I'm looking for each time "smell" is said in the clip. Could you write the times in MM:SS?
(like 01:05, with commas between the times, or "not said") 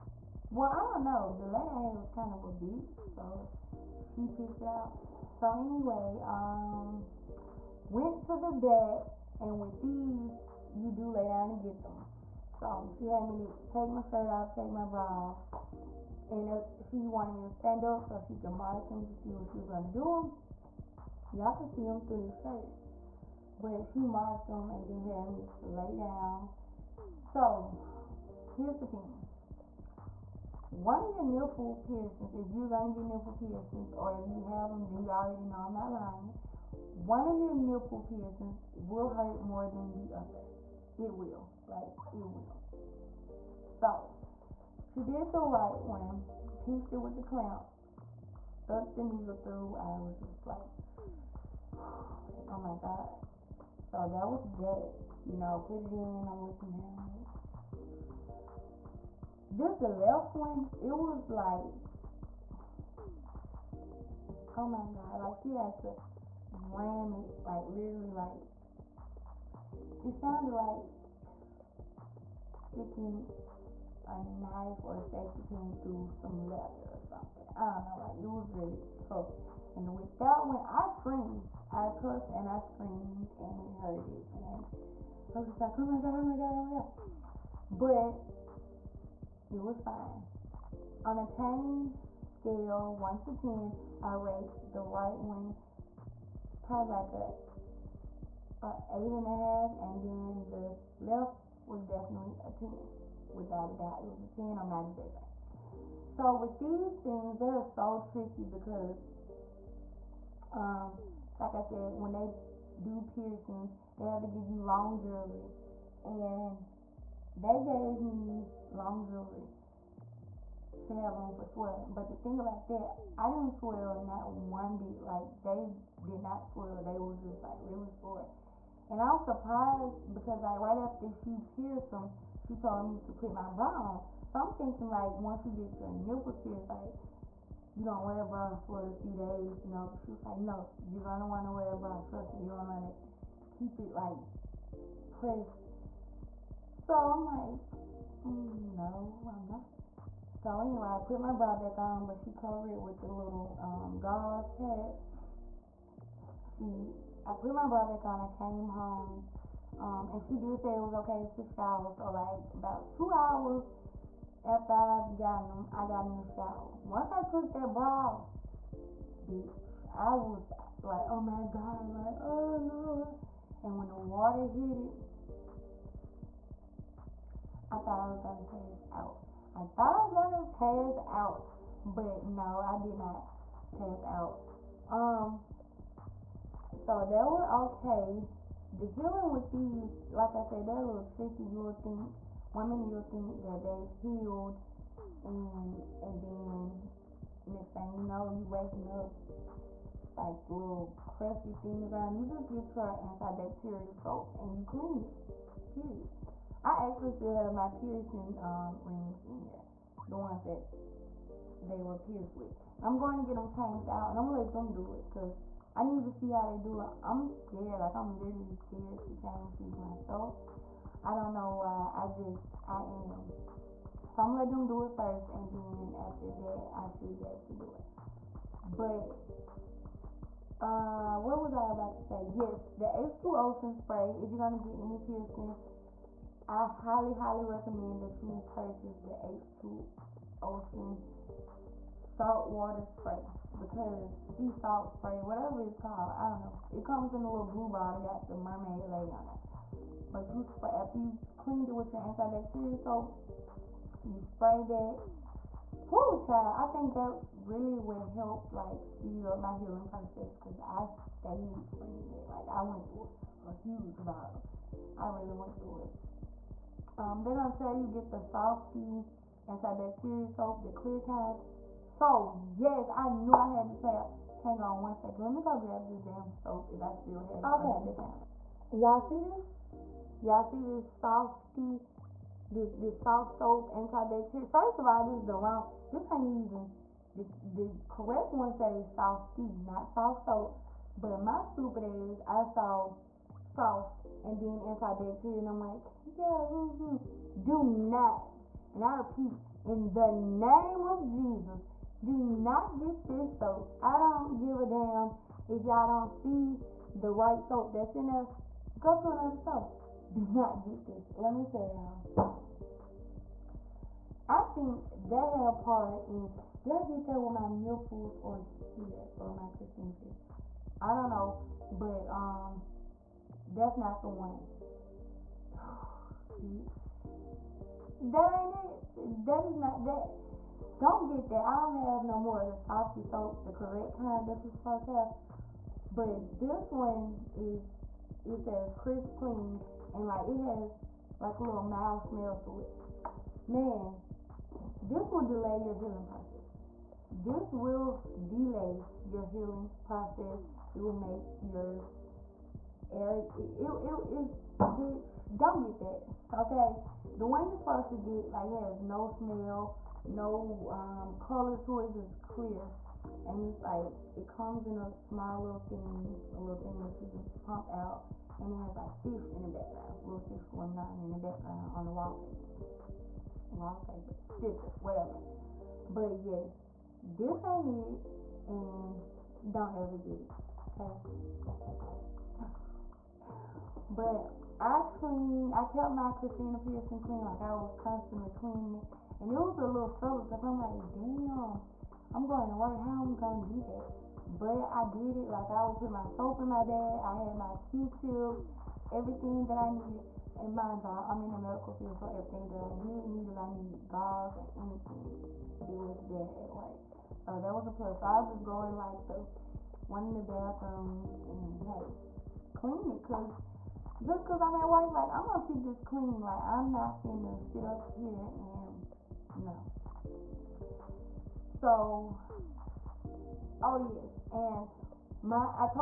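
05:42, 05:59.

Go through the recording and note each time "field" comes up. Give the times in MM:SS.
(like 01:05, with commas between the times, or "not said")
06:41.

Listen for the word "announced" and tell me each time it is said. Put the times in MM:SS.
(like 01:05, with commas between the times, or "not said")
not said.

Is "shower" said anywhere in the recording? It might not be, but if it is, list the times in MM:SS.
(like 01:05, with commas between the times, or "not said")
02:41, 02:46.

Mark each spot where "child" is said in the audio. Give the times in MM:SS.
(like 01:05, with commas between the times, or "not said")
04:16.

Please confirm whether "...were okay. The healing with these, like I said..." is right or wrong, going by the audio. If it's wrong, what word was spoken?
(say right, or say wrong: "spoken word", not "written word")
right.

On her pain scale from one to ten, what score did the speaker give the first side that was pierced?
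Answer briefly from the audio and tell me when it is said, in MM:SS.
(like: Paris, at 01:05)
8.5, at 01:38.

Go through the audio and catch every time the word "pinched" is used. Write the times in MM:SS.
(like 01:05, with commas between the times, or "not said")
00:46.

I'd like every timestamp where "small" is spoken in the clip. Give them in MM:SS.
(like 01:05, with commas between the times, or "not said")
06:05.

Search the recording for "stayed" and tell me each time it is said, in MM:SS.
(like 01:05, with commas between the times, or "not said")
04:21.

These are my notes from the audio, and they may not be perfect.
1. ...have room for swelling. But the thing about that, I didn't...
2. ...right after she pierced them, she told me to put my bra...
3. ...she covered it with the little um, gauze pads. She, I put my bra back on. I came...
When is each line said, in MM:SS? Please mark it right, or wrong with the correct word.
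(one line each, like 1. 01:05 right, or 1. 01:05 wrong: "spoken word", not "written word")
1. 02:00 right
2. 02:10 right
3. 02:32 right.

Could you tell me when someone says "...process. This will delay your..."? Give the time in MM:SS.
05:46.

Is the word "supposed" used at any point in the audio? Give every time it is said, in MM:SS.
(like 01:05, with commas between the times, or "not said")
05:34, 05:57.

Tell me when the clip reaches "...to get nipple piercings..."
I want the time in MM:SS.
00:32.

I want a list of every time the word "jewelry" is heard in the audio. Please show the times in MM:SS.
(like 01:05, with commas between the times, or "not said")
01:55, 01:59.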